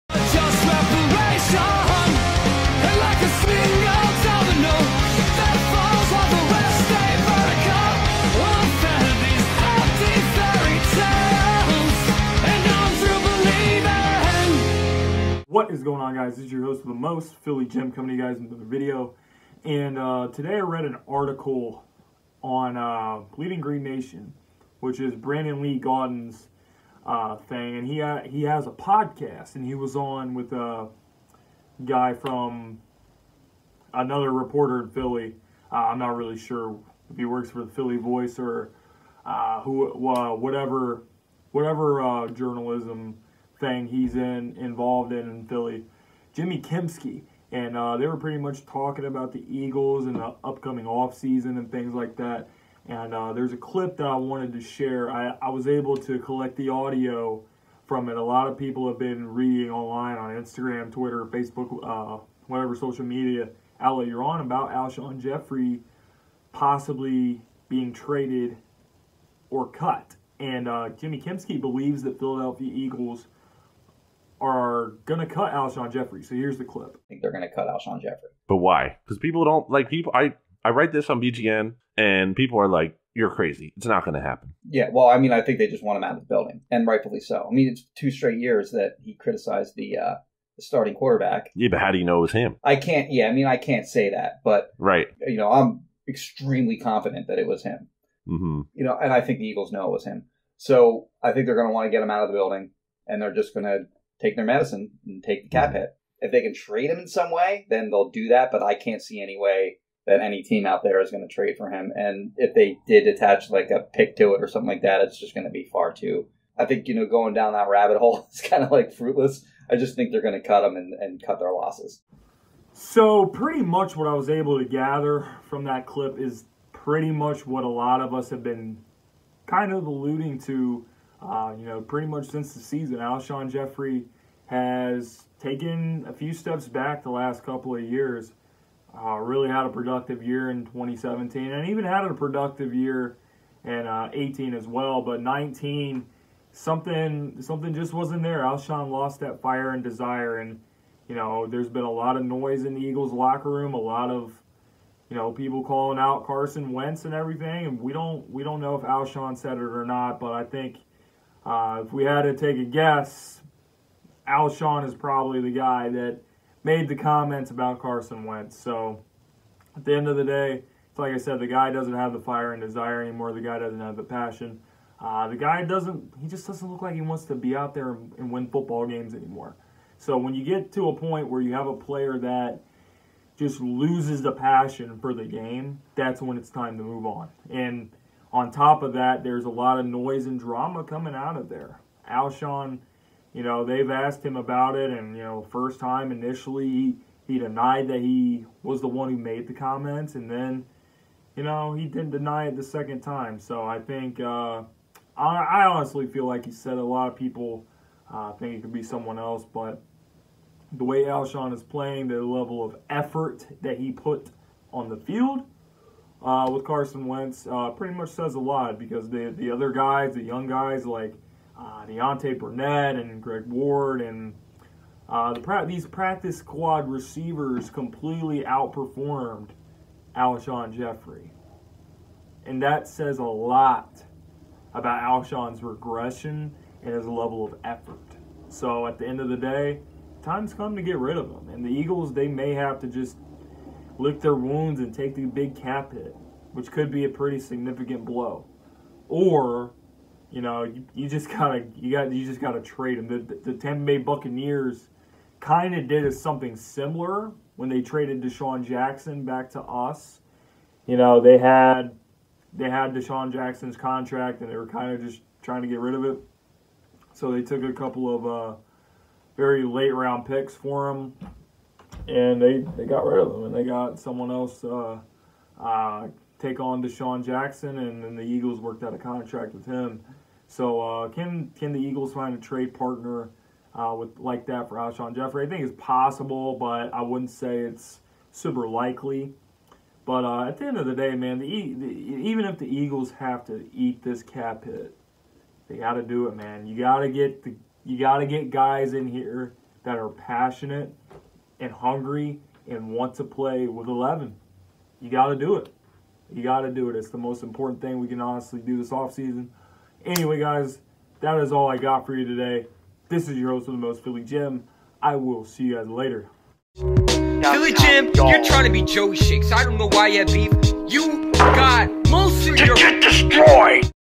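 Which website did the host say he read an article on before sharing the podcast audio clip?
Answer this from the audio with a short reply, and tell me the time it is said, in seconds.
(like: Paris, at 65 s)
Bleeding Green Nation, at 23 s.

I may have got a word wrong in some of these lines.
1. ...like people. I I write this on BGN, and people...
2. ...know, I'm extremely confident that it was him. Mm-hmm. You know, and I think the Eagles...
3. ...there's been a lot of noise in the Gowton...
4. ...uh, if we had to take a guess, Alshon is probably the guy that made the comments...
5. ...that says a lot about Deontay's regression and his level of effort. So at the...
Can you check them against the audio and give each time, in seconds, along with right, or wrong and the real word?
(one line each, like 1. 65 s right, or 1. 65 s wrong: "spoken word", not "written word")
1. 79 s right
2. 95 s right
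3. 151 s wrong: "Eagles", not "Gowton"
4. 161 s right
5. 232 s wrong: "Alshon", not "Deontay".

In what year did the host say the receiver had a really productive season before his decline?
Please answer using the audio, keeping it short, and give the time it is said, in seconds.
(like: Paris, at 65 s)
2017, at 140 s.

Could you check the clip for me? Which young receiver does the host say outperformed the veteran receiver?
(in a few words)
Deontay Burnett.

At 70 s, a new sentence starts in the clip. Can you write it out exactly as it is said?
And uh, Jimmy Kempski believes that Philadelphia Eagles – are gonna cut Alshon Jeffery.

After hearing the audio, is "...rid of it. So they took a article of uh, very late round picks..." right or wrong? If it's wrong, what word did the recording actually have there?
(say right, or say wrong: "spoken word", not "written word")
wrong: "couple", not "article".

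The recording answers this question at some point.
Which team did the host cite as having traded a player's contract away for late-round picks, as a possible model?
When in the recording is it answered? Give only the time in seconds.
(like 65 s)
253 s.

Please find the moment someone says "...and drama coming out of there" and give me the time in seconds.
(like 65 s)
190 s.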